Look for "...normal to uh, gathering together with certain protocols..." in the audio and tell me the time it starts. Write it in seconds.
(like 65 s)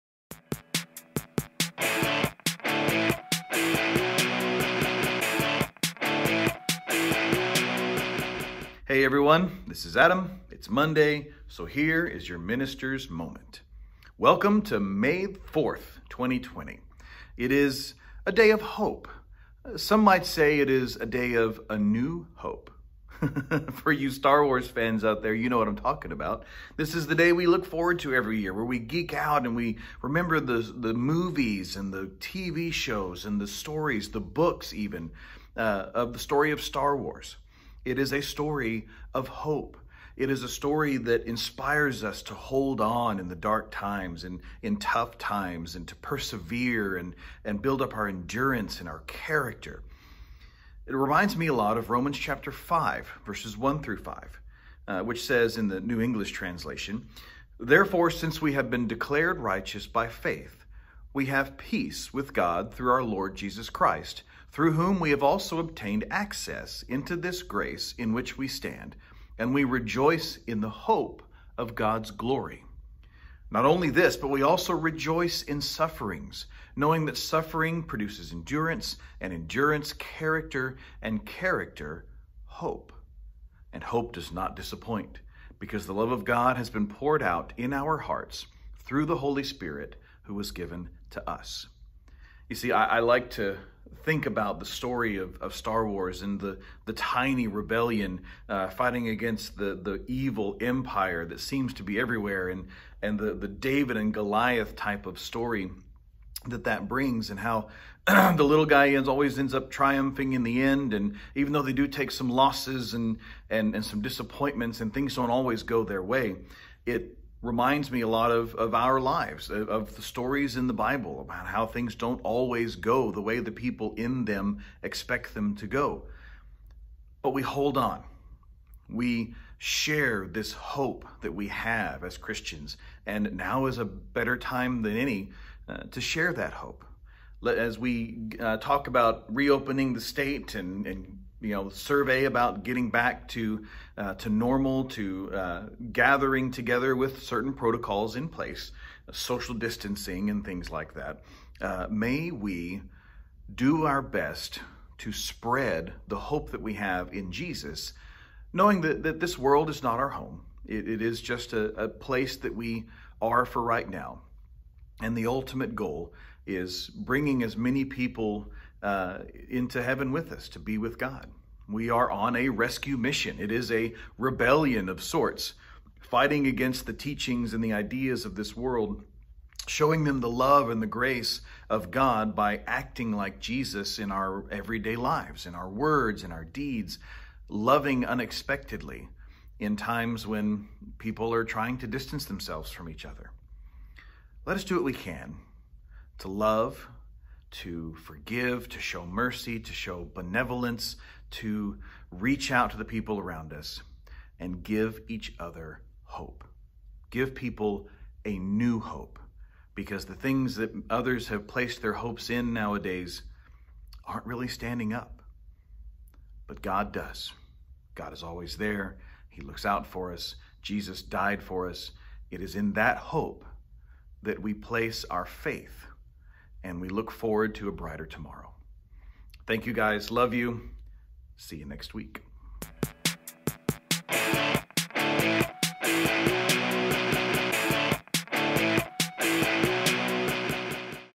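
144 s.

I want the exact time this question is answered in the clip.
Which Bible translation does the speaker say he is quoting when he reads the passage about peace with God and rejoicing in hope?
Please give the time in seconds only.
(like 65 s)
55 s.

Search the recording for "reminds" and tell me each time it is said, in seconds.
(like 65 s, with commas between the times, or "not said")
50 s, 117 s.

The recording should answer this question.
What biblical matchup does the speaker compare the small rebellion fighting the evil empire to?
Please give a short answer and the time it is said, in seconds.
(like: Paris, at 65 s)
David and Goliath, at 103 s.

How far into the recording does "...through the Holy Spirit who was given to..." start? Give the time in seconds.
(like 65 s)
88 s.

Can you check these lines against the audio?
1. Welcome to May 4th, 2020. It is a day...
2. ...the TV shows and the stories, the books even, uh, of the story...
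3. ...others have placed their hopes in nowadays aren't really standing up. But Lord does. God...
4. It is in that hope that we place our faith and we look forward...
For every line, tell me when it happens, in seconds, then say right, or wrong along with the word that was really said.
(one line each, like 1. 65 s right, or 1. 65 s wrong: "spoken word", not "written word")
1. 14 s right
2. 31 s right
3. 210 s wrong: "God", not "Lord"
4. 222 s right.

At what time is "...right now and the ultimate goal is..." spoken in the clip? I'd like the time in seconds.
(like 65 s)
163 s.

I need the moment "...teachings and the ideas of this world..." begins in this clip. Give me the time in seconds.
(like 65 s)
176 s.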